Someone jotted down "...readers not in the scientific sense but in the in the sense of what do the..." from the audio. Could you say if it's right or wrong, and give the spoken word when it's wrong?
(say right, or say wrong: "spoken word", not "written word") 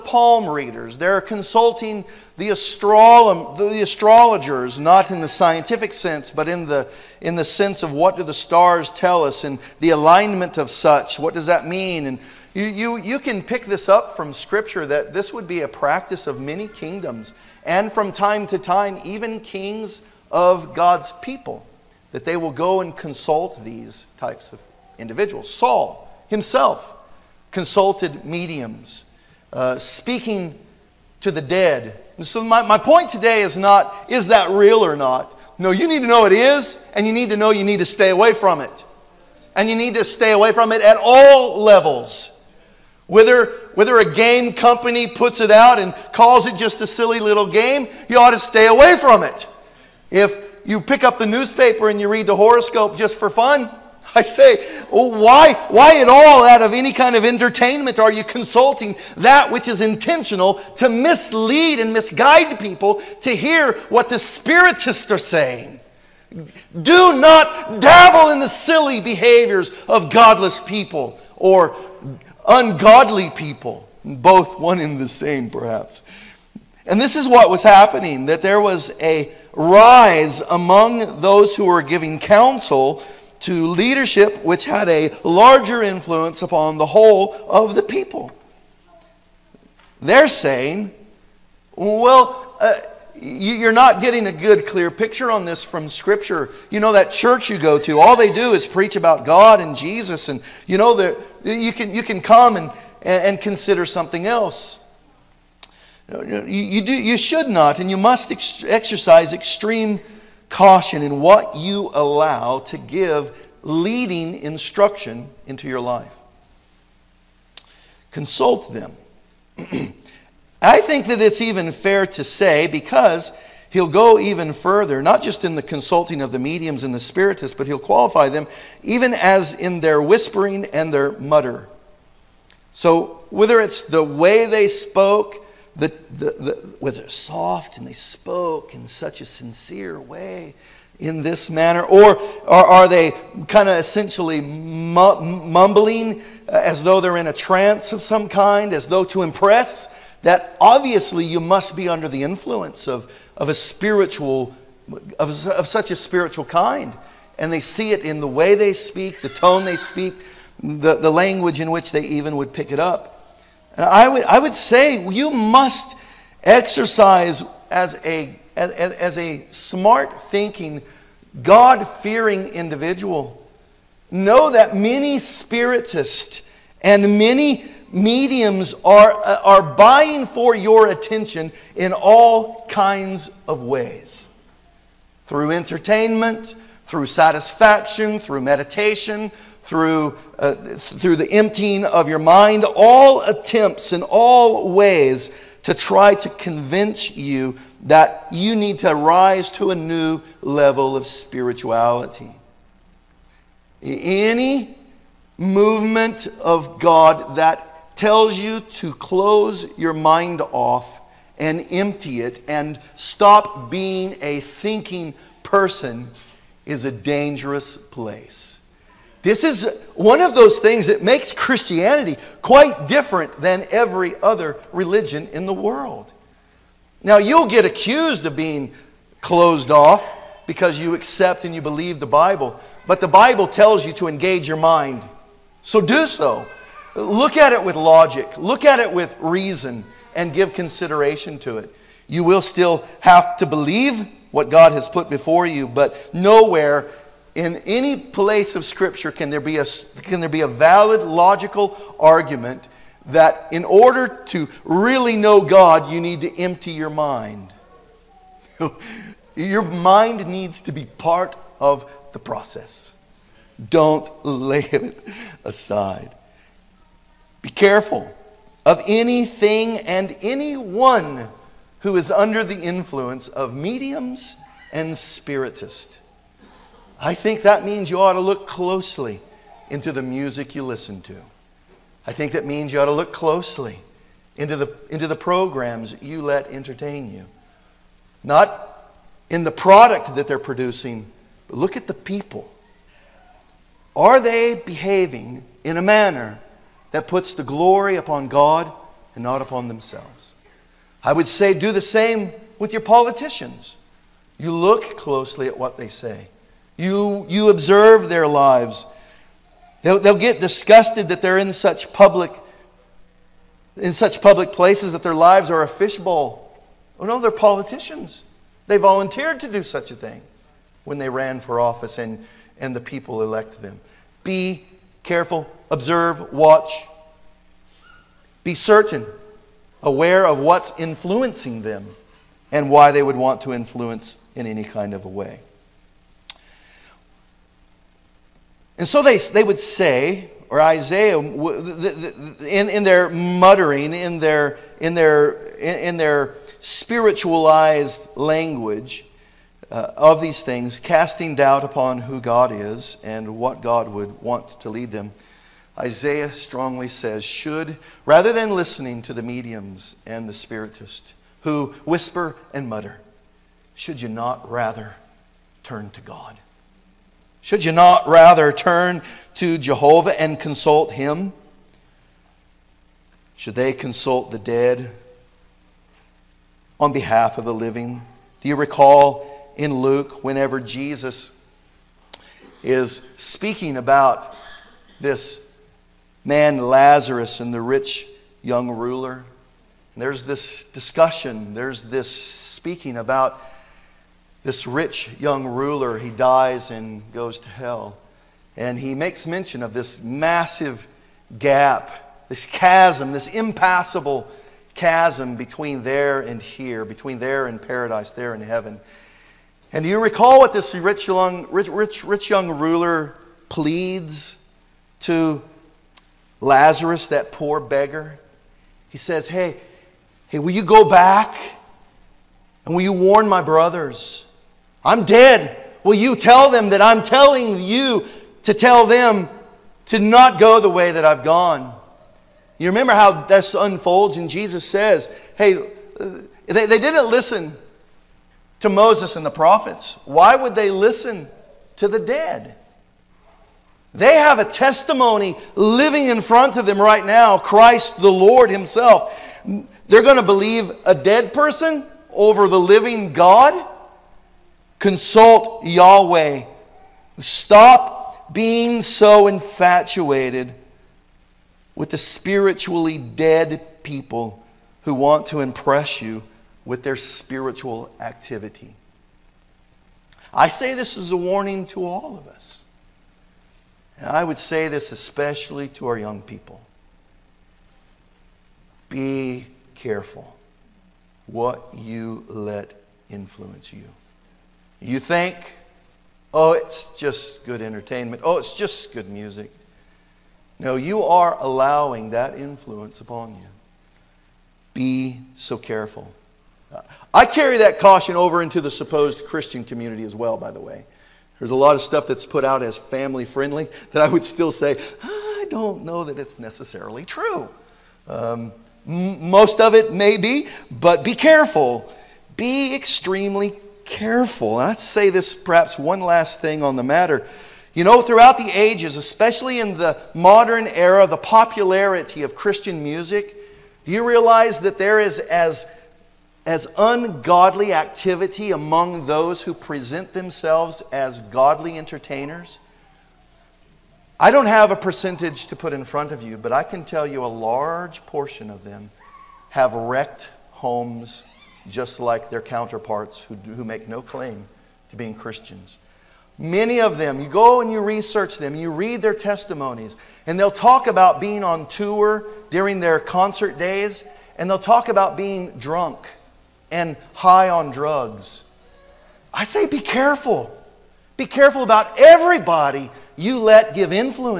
wrong: "astrologers", not "readers".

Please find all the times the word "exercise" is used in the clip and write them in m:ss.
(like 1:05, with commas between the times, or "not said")
1:48, 2:46.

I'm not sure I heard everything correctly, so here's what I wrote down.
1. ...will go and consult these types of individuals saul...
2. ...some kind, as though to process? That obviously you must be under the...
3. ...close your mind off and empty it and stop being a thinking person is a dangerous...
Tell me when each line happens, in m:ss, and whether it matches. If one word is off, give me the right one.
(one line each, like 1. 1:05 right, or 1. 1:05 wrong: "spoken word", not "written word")
1. 0:22 right
2. 2:28 wrong: "impress", not "process"
3. 3:28 right.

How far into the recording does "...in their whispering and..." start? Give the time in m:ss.
2:09.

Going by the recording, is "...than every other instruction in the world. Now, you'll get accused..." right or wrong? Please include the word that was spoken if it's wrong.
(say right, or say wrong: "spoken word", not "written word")
wrong: "religion", not "instruction".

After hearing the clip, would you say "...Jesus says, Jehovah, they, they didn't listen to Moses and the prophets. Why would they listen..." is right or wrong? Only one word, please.
wrong.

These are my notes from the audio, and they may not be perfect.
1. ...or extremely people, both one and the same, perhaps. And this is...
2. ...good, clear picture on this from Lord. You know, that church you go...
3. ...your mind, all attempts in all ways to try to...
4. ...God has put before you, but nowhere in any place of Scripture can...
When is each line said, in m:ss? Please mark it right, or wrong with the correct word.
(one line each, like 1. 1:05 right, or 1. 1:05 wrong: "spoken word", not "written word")
1. 1:11 wrong: "ungodly", not "extremely"
2. 1:34 wrong: "Scripture", not "Lord"
3. 3:12 right
4. 4:04 right.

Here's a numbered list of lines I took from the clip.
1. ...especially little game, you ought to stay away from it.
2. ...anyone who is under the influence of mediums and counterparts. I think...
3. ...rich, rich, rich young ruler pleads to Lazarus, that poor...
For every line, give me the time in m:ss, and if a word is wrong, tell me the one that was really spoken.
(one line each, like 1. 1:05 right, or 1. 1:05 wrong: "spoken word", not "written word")
1. 0:46 wrong: "silly", not "especially"
2. 4:30 wrong: "spiritists", not "counterparts"
3. 6:51 right.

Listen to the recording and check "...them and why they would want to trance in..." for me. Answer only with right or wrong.
wrong.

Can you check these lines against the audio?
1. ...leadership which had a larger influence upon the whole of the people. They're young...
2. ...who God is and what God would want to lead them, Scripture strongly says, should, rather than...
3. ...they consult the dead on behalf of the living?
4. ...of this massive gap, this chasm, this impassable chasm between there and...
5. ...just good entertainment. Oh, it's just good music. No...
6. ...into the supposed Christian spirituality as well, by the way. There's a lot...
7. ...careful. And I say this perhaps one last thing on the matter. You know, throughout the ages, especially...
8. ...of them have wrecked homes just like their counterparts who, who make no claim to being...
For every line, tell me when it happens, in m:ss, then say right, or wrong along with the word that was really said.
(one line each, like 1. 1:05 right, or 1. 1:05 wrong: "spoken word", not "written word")
1. 1:23 wrong: "saying", not "young"
2. 5:51 wrong: "Isaiah", not "Scripture"
3. 6:13 right
4. 6:39 right
5. 8:06 right
6. 8:18 wrong: "community", not "spirituality"
7. 8:33 right
8. 8:58 right.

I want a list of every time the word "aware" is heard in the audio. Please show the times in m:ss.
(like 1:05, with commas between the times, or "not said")
5:29.